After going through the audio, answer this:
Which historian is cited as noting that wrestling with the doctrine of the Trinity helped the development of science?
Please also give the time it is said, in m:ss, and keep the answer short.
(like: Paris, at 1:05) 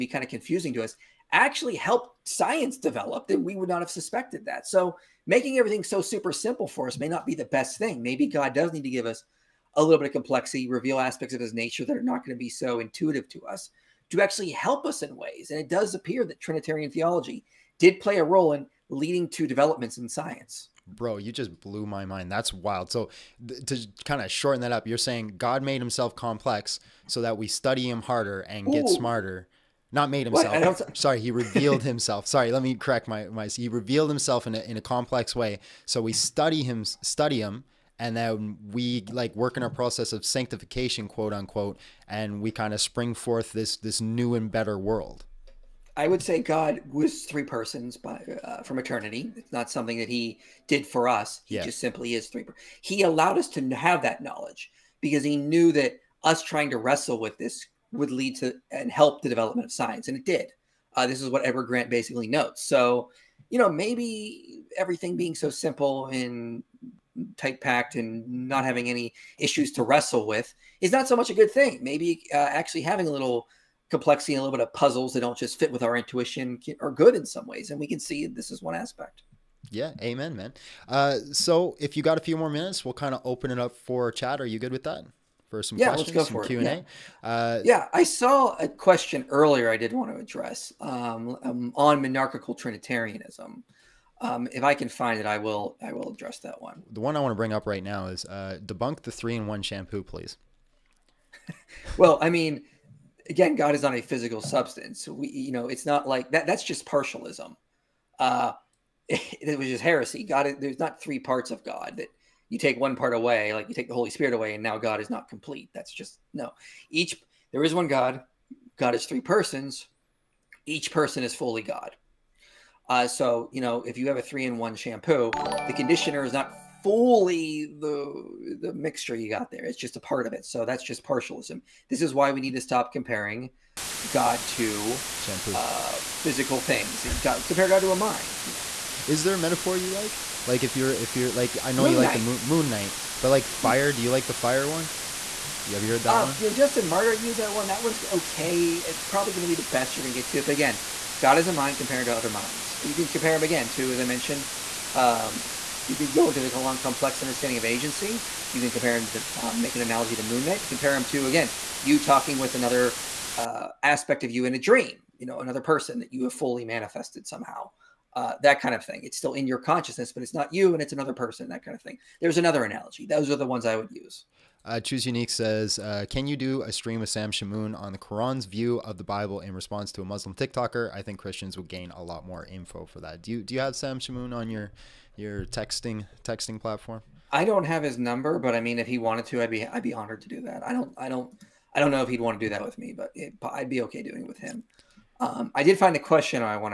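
Edward Grant, at 1:01.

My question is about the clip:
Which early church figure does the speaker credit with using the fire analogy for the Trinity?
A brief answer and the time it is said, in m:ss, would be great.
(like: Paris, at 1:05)
Justin Martyr, at 2:26.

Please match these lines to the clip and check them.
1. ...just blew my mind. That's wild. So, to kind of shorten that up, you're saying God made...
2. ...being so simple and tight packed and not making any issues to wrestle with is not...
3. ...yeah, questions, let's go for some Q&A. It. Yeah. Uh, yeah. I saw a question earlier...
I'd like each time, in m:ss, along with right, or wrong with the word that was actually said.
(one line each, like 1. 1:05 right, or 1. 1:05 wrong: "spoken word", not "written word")
1. 0:21 right
2. 1:05 wrong: "having", not "making"
3. 1:25 right.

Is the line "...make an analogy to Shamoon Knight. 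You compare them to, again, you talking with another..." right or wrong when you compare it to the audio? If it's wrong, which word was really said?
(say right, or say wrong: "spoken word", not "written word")
wrong: "Moon", not "Shamoon".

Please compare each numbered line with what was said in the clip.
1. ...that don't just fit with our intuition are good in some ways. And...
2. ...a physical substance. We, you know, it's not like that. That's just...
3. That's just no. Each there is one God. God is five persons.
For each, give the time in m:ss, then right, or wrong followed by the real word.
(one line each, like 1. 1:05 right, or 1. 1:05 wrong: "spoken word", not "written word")
1. 1:15 right
2. 1:43 right
3. 1:55 wrong: "three", not "five".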